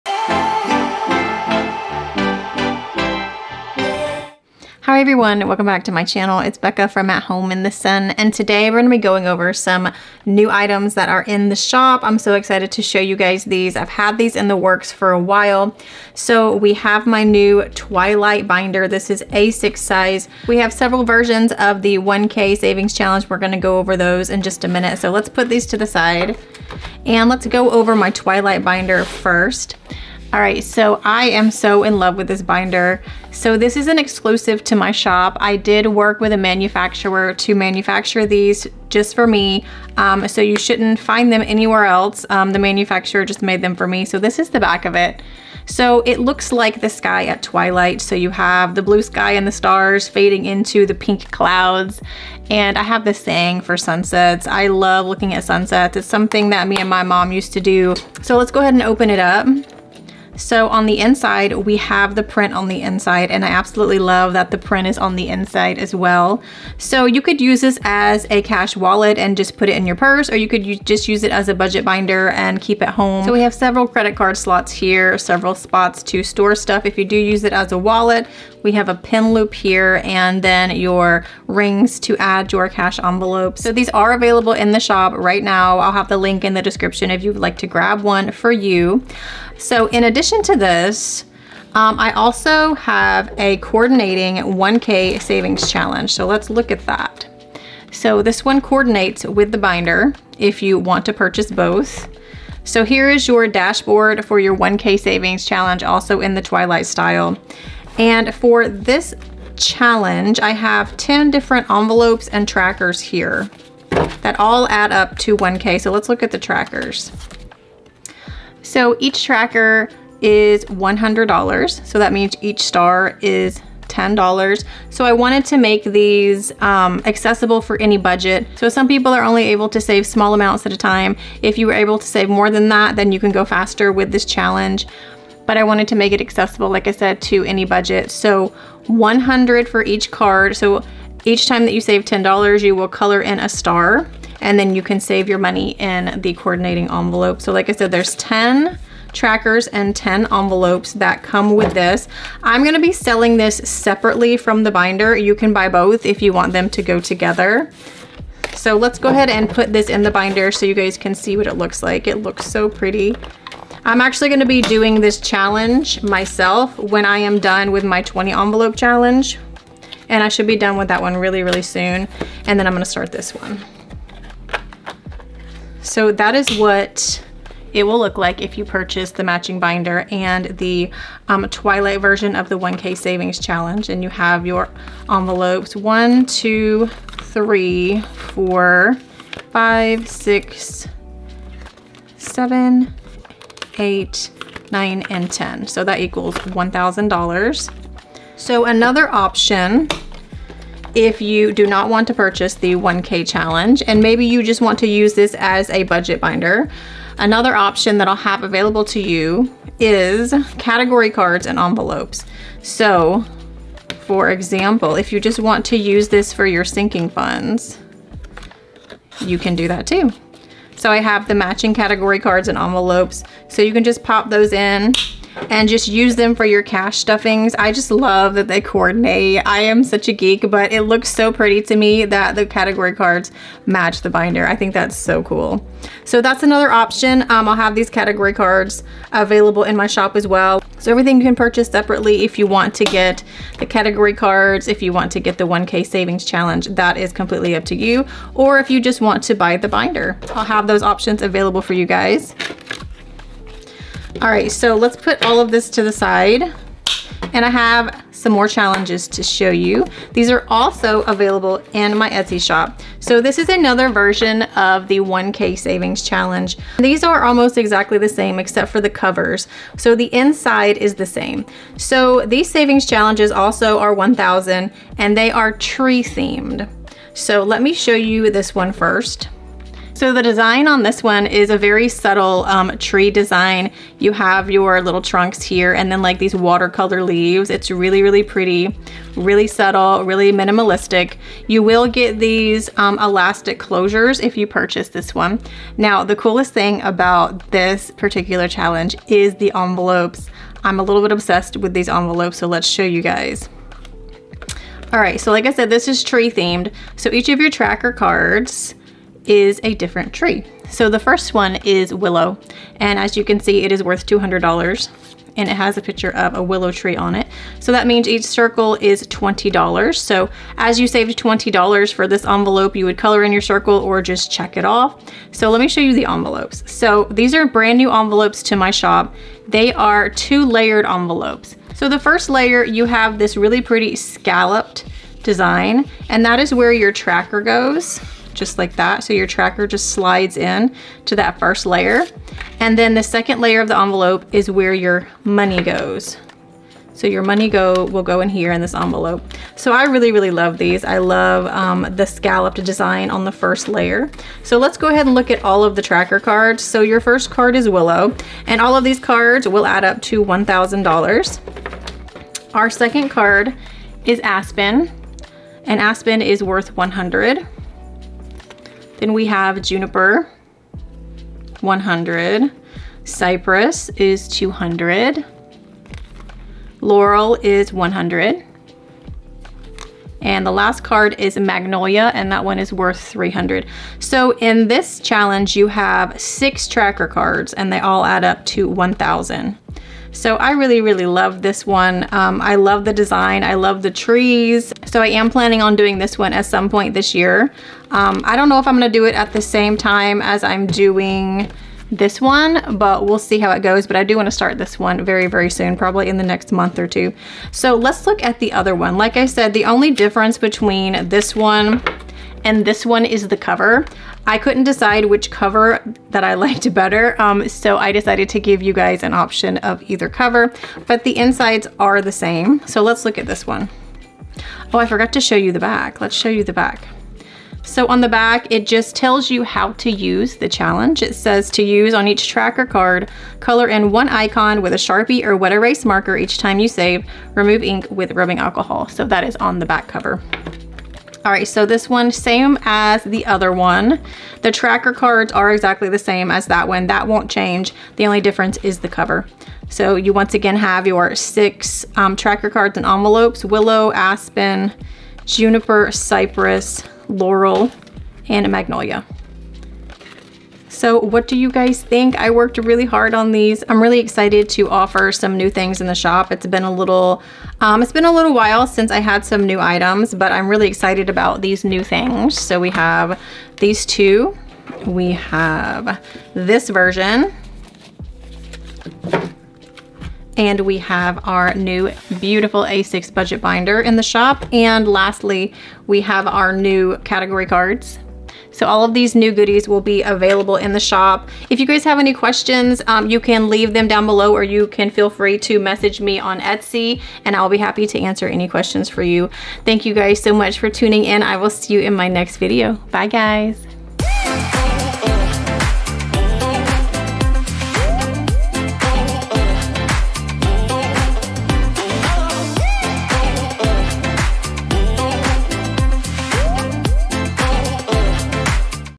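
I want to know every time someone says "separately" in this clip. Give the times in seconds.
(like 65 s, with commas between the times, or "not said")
153 s, 241 s.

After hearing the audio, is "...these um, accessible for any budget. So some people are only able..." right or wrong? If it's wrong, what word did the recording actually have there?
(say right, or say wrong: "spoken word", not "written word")
right.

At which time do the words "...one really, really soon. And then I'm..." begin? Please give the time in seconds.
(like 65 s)
171 s.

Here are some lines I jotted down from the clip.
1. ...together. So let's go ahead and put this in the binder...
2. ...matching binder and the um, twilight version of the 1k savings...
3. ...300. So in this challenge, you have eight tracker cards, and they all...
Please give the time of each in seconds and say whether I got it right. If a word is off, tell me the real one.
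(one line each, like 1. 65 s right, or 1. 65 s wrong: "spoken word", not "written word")
1. 156 s right
2. 179 s right
3. 383 s wrong: "six", not "eight".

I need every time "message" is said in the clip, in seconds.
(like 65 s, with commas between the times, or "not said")
495 s.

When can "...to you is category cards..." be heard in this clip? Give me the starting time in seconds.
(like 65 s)
208 s.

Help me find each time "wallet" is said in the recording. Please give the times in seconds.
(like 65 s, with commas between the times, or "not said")
68 s, 77 s.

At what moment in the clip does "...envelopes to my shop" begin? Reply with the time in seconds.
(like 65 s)
327 s.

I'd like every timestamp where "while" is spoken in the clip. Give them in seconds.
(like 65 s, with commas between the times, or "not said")
15 s, 468 s.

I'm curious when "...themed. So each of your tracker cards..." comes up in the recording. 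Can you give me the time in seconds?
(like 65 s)
306 s.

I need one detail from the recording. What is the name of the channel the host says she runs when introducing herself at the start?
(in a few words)
At Home in the Sun.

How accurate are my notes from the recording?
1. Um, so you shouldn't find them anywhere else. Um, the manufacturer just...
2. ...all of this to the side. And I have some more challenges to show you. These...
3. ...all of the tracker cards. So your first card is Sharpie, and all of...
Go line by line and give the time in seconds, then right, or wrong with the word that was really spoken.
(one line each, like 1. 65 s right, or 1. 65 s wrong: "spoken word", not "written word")
1. 39 s right
2. 255 s right
3. 355 s wrong: "Willow", not "Sharpie".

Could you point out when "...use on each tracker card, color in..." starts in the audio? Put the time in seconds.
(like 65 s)
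431 s.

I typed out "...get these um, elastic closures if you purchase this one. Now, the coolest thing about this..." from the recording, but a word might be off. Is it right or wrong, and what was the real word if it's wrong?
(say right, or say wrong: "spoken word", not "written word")
right.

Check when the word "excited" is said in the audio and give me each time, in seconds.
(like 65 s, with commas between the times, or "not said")
12 s, 463 s, 470 s.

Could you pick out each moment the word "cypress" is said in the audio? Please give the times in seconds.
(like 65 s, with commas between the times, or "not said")
373 s, 455 s.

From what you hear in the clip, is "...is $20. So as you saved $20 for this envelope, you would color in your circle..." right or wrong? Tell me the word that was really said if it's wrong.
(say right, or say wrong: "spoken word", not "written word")
right.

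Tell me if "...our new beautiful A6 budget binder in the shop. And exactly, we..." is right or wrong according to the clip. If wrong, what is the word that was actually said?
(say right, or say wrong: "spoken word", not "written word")
wrong: "lastly", not "exactly".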